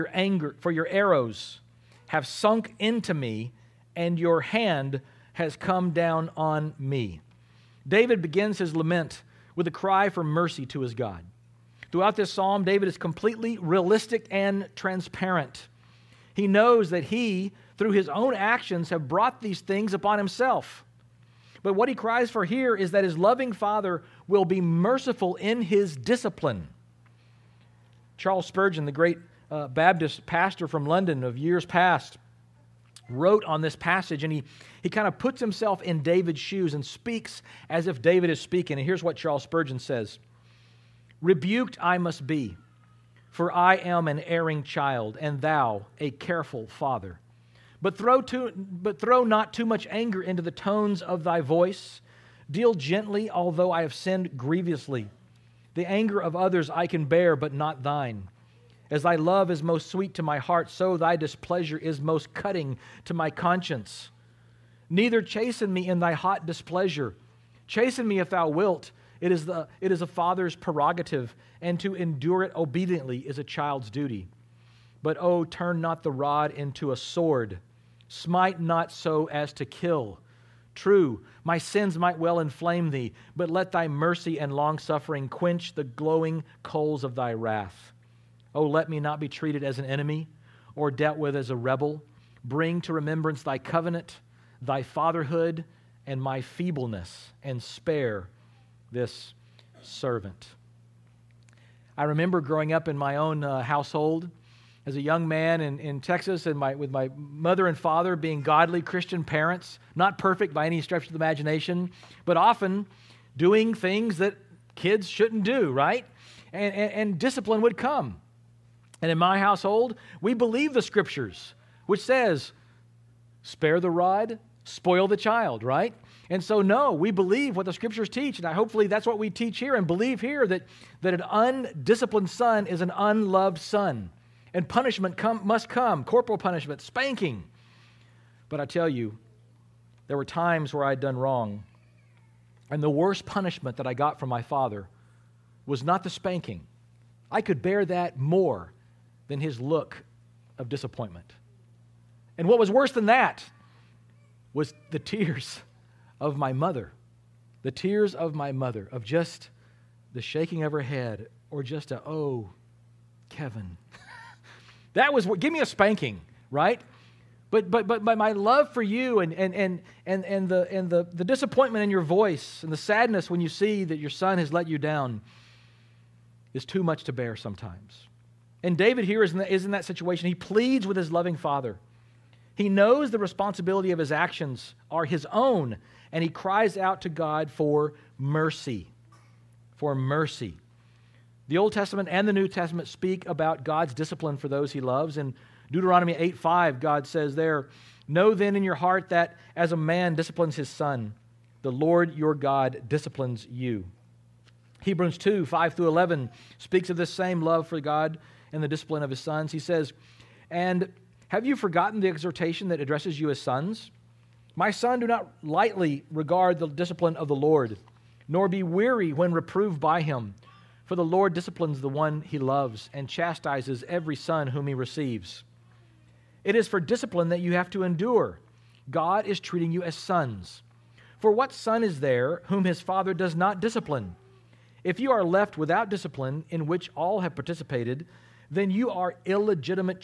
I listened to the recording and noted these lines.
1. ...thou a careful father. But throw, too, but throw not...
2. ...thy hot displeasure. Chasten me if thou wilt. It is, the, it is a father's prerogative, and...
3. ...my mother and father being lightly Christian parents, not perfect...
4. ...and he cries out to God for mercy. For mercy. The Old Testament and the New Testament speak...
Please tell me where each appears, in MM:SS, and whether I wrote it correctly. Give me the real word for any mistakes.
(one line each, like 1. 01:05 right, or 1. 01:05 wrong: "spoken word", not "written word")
1. 00:45 right
2. 01:05 right
3. 01:46 wrong: "godly", not "lightly"
4. 03:06 right.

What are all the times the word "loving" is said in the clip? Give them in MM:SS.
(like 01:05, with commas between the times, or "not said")
00:23, 03:01.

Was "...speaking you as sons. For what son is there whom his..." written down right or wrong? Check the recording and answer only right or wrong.
wrong.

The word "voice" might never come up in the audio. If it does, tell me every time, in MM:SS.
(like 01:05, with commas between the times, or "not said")
00:51, 02:52.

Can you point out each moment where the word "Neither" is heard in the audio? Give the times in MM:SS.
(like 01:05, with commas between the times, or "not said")
01:04.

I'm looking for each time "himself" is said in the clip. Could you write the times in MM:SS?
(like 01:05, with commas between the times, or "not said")
00:20, 00:35.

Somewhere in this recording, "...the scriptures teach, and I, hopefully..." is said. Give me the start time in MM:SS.
02:07.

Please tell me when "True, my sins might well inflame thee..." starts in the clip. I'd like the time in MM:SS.
01:20.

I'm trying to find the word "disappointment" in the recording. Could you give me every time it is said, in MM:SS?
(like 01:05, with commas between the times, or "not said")
02:30, 02:51.